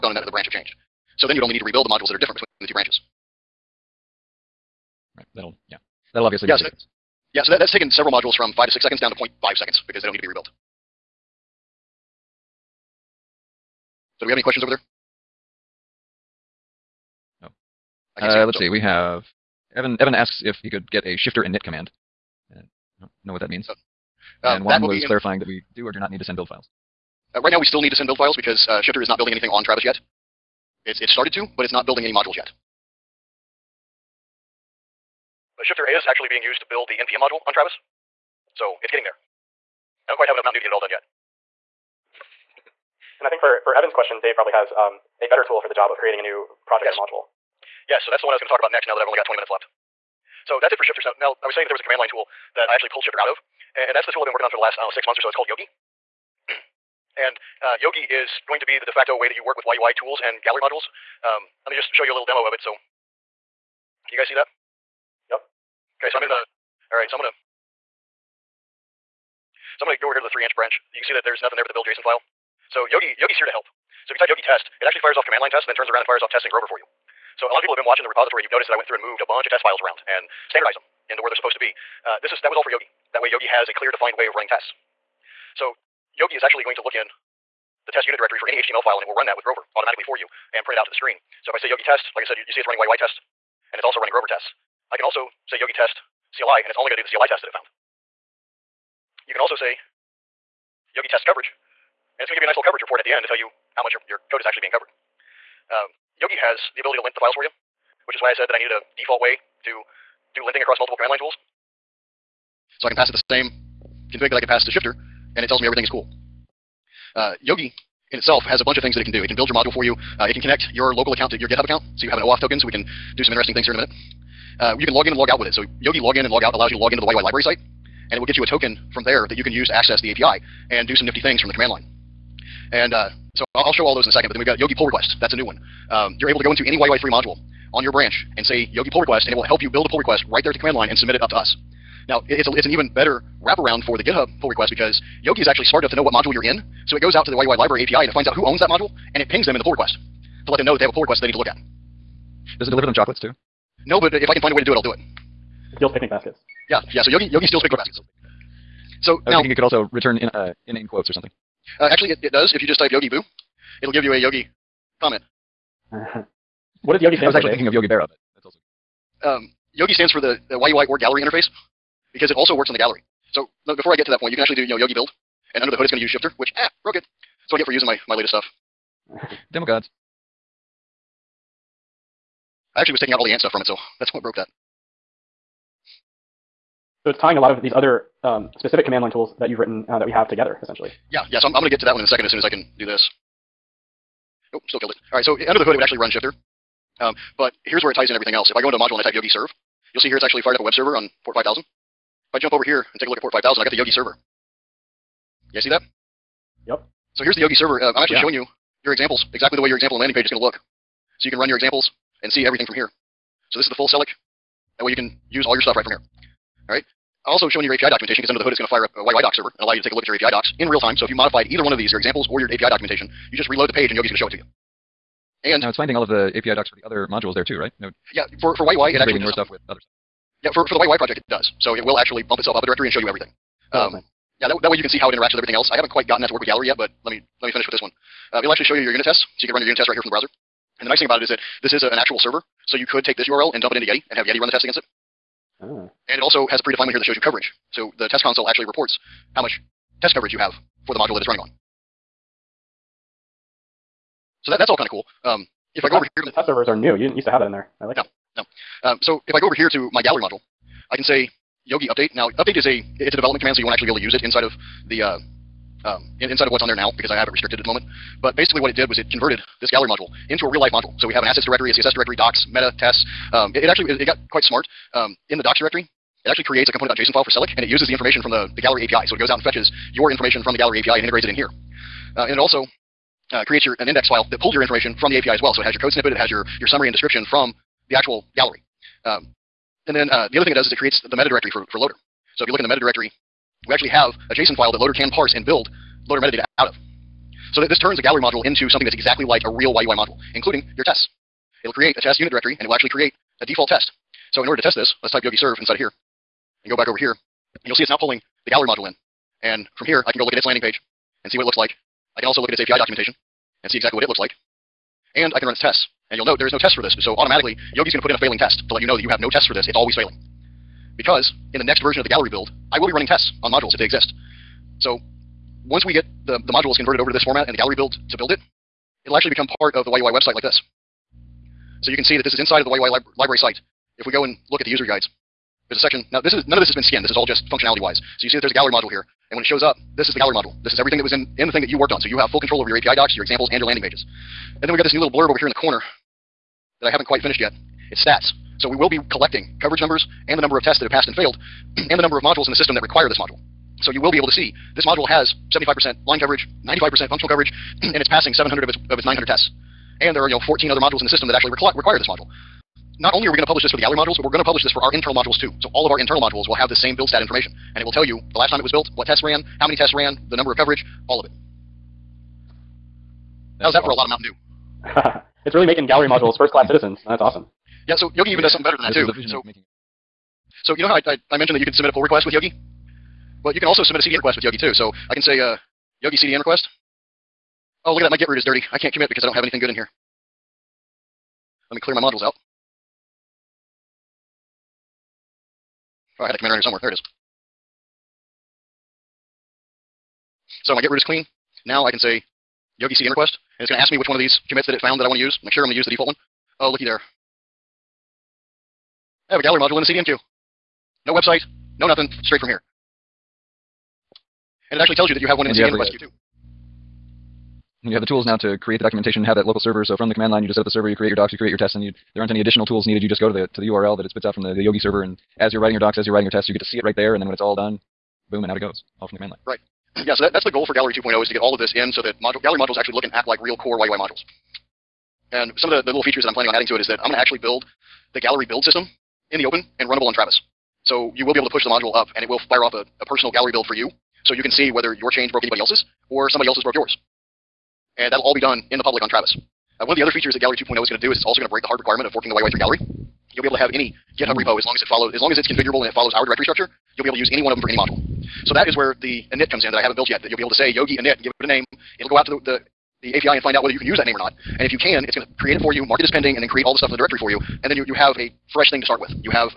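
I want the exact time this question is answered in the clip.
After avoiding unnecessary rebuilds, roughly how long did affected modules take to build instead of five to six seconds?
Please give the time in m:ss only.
0:09.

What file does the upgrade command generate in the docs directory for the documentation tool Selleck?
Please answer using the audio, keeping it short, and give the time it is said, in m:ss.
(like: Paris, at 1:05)
component.json, at 4:36.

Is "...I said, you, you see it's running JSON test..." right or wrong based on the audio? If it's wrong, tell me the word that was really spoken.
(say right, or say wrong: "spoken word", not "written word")
wrong: "YUI", not "JSON".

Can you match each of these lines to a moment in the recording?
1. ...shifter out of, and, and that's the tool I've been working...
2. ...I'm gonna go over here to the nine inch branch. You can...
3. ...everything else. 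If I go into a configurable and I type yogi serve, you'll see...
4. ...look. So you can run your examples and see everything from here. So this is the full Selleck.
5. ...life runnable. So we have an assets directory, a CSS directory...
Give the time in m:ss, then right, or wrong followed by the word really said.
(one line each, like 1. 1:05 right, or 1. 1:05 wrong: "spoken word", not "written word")
1. 0:53 right
2. 1:09 wrong: "three", not "nine"
3. 3:18 wrong: "module", not "configurable"
4. 3:30 right
5. 4:30 wrong: "module", not "runnable".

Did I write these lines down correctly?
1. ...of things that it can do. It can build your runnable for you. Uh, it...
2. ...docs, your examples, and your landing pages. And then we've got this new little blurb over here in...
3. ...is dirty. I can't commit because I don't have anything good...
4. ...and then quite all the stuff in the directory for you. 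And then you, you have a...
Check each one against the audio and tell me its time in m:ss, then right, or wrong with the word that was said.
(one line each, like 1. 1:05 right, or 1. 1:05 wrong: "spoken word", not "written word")
1. 1:58 wrong: "module", not "runnable"
2. 5:42 right
3. 6:28 right
4. 7:46 wrong: "create", not "quite".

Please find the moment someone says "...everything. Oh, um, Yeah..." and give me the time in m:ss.
3:53.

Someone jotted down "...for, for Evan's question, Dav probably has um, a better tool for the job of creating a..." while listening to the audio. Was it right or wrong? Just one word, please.
right.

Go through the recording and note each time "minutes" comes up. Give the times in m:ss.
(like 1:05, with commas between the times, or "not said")
0:49, 2:03.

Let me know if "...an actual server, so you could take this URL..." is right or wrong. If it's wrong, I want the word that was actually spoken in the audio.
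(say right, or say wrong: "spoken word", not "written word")
right.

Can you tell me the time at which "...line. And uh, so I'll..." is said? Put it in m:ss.
2:11.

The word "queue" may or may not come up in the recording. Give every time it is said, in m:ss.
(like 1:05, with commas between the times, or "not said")
6:50, 6:55.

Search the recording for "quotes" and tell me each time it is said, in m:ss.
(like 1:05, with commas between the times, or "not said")
2:40.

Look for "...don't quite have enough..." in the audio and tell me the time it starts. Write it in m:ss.
0:40.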